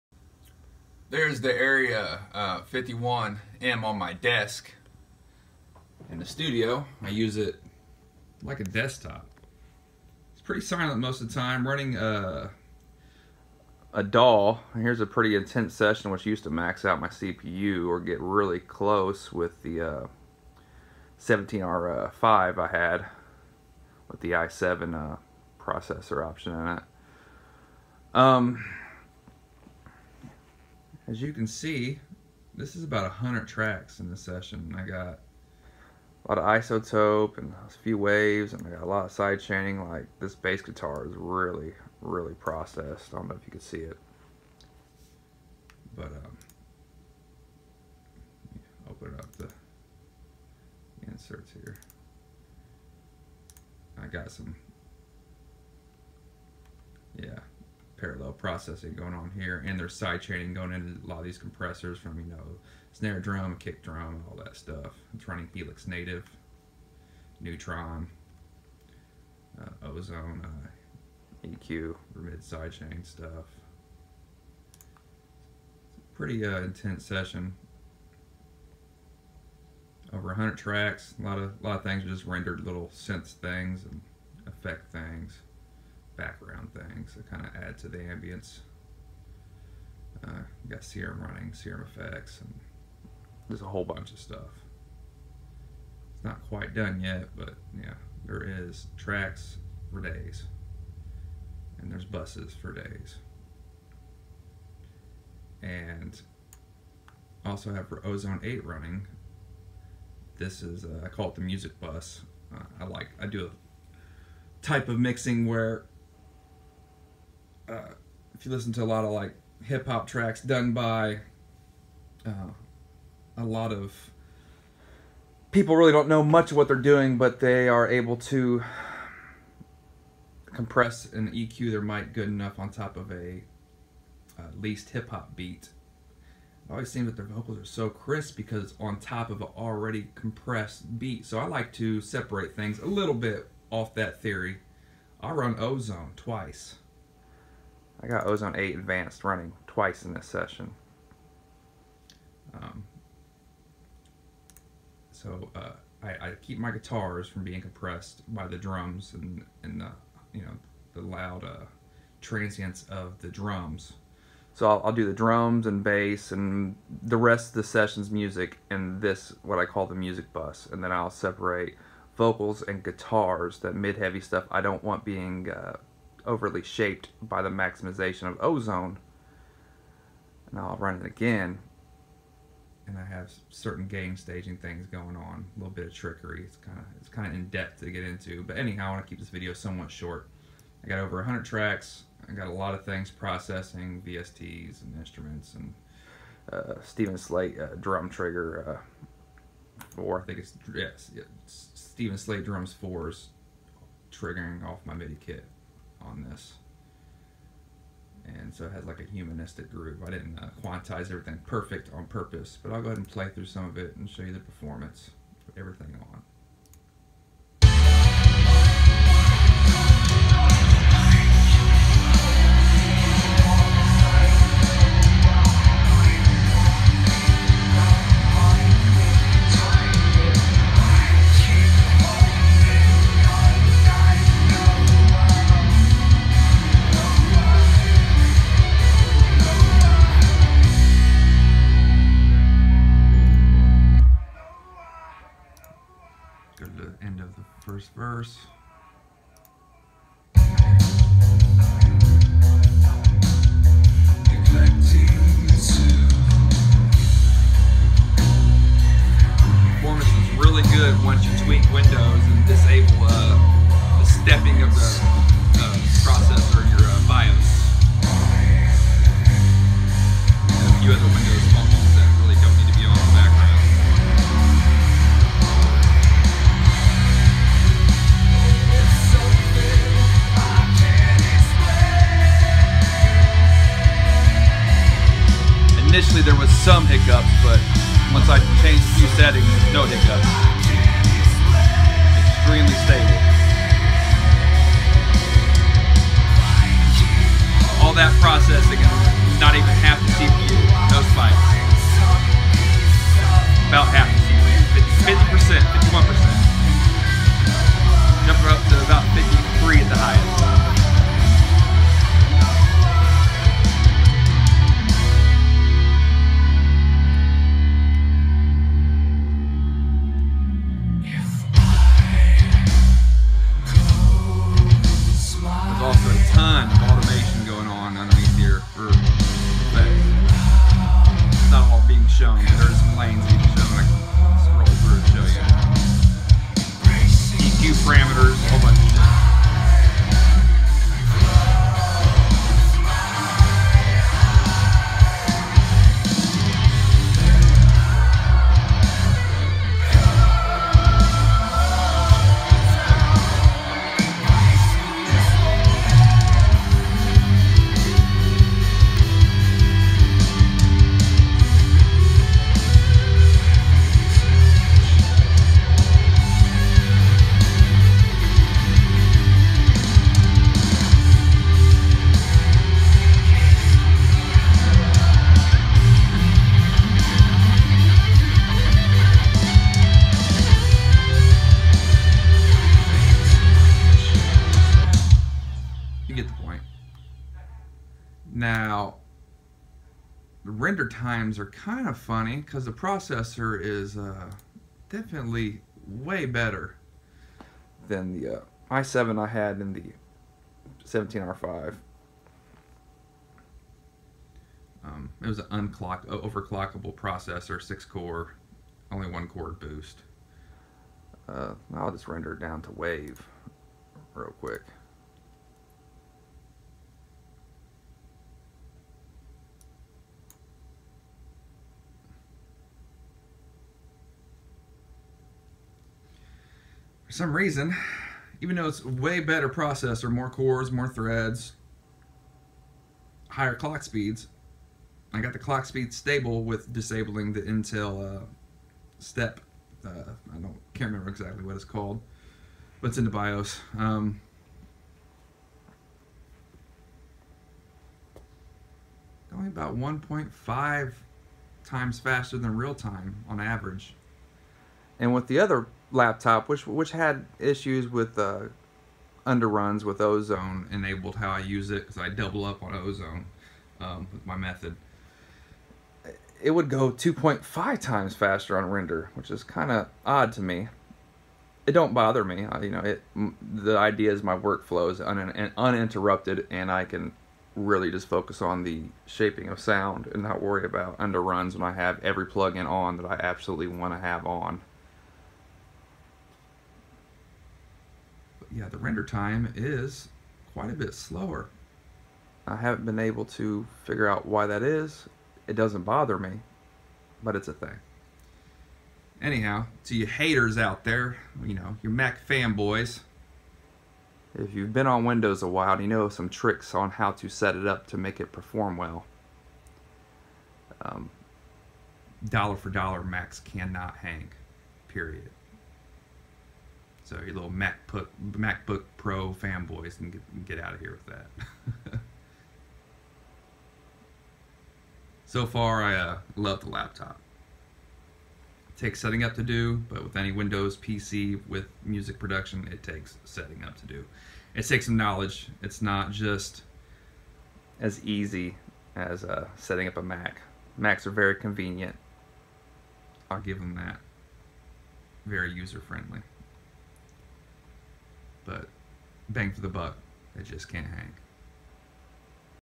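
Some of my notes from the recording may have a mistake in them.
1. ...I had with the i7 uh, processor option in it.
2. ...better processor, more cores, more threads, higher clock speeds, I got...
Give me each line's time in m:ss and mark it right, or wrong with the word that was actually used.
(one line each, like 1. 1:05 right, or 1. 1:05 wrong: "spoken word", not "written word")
1. 0:22 right
2. 7:09 right.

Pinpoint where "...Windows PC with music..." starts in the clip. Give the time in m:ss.
8:50.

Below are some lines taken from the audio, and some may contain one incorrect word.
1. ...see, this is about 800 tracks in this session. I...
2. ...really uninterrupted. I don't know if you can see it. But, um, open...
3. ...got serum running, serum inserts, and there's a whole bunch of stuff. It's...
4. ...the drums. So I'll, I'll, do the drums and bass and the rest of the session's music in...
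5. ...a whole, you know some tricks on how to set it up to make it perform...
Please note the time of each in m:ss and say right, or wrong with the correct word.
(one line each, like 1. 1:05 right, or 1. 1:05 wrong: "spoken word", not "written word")
1. 0:31 wrong: "100", not "800"
2. 0:42 wrong: "processed", not "uninterrupted"
3. 1:30 wrong: "effects", not "inserts"
4. 2:43 right
5. 8:25 wrong: "while", not "whole".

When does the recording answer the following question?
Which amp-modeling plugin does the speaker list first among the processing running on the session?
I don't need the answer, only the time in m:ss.
1:05.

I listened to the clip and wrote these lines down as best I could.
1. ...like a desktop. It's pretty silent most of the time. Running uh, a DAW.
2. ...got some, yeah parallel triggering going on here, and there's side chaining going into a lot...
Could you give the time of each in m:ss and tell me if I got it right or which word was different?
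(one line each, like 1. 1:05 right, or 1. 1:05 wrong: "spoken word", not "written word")
1. 0:08 right
2. 0:54 wrong: "processing", not "triggering".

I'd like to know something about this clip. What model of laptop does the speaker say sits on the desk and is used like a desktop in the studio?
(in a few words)
Area 51M.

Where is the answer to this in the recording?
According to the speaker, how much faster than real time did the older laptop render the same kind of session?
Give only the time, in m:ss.
7:46.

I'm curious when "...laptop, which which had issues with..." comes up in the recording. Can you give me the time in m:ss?
7:35.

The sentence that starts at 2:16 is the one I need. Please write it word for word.
It always seems that their vocals are so crisp because on top of an already compressed beat.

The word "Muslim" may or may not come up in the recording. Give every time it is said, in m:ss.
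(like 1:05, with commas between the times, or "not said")
not said.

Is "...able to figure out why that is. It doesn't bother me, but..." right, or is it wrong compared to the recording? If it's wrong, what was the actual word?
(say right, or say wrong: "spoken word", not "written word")
right.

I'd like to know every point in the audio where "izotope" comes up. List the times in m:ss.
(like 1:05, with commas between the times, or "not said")
0:36.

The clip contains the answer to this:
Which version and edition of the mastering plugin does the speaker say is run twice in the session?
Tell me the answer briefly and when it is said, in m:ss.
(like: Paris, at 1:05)
Ozone 8 Advanced, at 2:28.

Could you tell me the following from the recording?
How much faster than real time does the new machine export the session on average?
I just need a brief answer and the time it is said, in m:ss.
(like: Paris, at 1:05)
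1.5 times, at 7:29.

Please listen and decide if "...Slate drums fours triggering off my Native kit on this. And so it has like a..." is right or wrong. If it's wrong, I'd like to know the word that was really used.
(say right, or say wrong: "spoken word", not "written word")
wrong: "MIDI", not "Native".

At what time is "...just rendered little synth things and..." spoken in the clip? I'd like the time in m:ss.
1:22.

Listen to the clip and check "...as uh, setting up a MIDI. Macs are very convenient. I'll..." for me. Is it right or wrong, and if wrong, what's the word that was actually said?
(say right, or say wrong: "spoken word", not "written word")
wrong: "Mac", not "MIDI".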